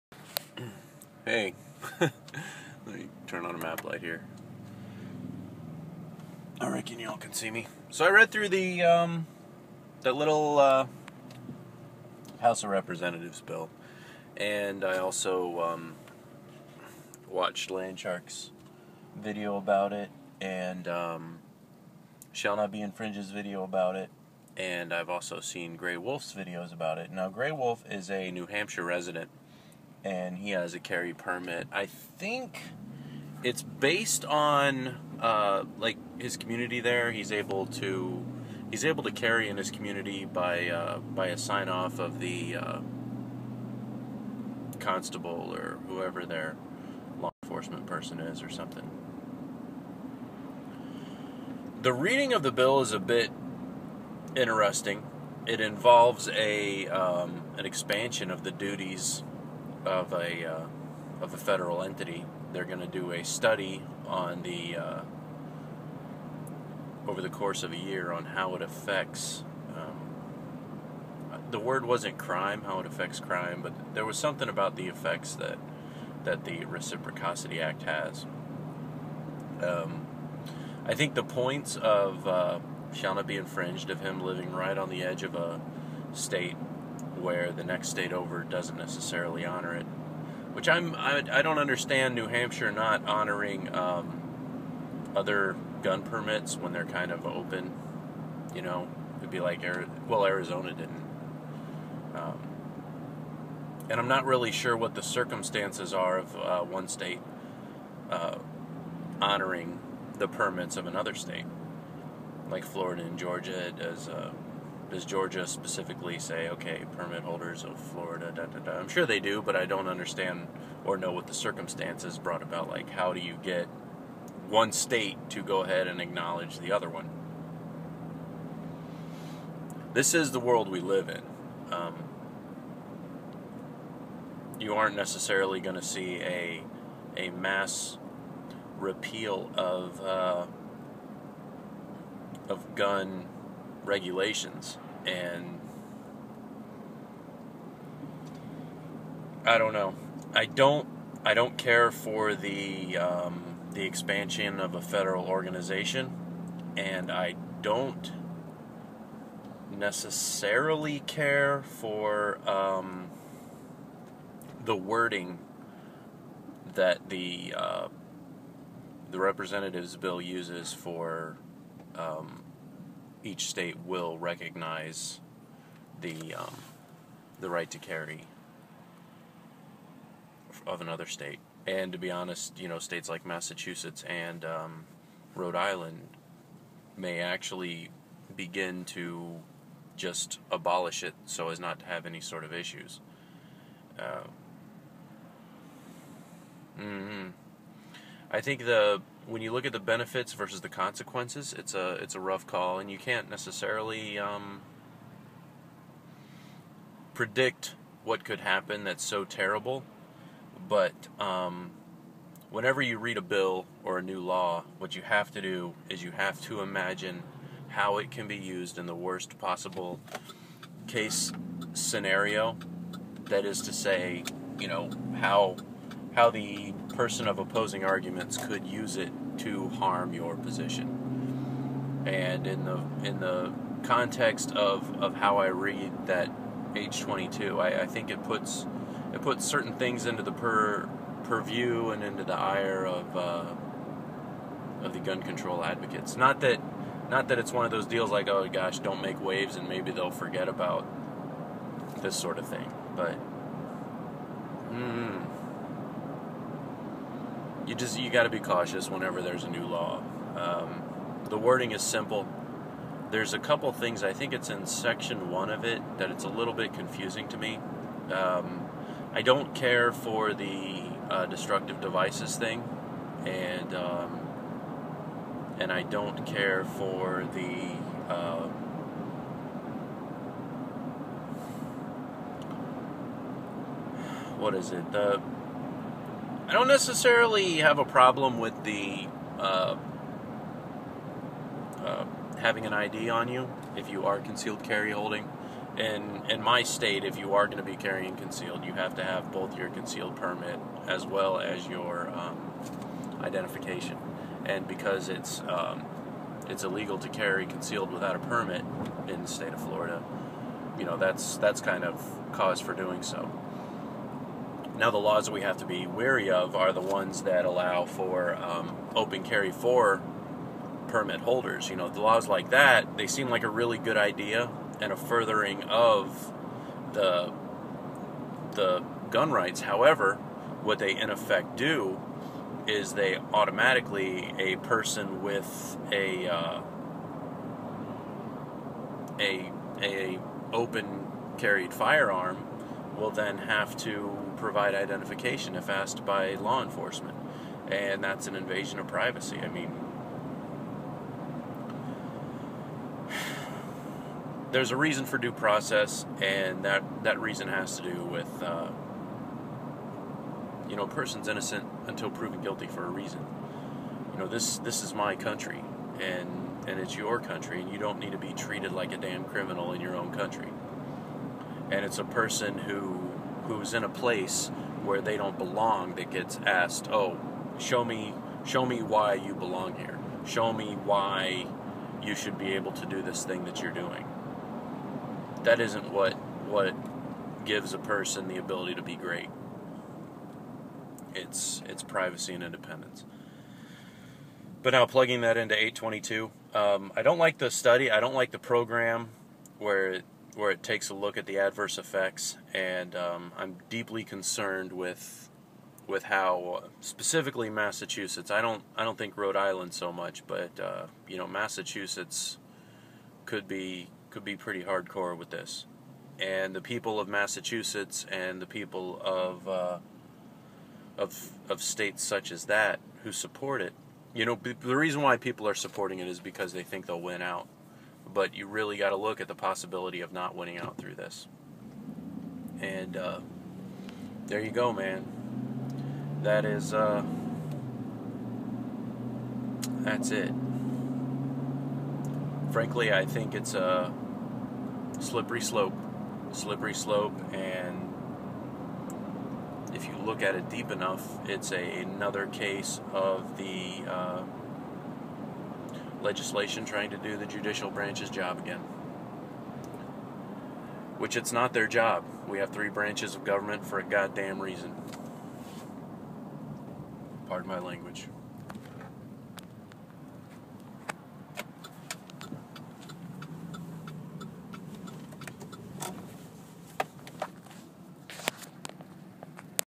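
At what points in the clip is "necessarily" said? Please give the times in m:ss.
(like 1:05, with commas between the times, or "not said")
1:28, 2:14, 2:39, 3:23, 4:46.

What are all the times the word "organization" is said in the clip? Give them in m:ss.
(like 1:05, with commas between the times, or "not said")
2:35.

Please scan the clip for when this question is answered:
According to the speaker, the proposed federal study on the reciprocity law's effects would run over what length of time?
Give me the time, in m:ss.
1:07.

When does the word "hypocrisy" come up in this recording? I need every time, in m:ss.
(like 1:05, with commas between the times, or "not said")
not said.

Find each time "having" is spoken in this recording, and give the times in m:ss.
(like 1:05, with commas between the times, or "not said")
4:52.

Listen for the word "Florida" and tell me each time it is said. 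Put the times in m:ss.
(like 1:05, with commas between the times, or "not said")
1:52, 1:57, 5:09.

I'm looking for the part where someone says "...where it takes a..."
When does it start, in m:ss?
6:40.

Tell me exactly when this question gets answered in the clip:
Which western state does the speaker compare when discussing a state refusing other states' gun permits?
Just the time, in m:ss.
1:40.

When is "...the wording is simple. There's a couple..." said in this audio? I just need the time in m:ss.
4:21.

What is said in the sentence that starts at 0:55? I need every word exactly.
It involves a um, an expansion of the duties of a uh, of a federal entity.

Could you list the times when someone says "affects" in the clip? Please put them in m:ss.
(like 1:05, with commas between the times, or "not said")
1:08, 1:12.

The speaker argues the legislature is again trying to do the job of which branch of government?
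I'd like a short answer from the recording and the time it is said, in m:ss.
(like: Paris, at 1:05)
the judicial branch, at 7:37.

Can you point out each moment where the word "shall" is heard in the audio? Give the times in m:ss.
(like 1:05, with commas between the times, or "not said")
0:22, 1:22.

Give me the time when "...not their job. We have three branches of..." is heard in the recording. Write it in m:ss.
7:41.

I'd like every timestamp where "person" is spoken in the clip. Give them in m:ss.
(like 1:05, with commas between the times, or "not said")
0:47, 3:46, 5:34, 6:00, 6:12, 6:27.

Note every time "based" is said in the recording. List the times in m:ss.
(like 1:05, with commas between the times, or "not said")
0:33.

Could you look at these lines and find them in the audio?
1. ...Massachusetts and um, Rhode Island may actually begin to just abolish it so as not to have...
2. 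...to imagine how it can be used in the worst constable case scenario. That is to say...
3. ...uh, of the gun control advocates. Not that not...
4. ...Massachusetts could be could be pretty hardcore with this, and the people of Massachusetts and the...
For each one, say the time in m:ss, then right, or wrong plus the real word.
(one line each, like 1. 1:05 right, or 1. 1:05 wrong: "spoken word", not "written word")
1. 3:03 right
2. 3:36 wrong: "possible", not "constable"
3. 4:03 right
4. 6:51 right.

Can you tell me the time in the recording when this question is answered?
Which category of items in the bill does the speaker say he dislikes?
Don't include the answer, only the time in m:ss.
4:31.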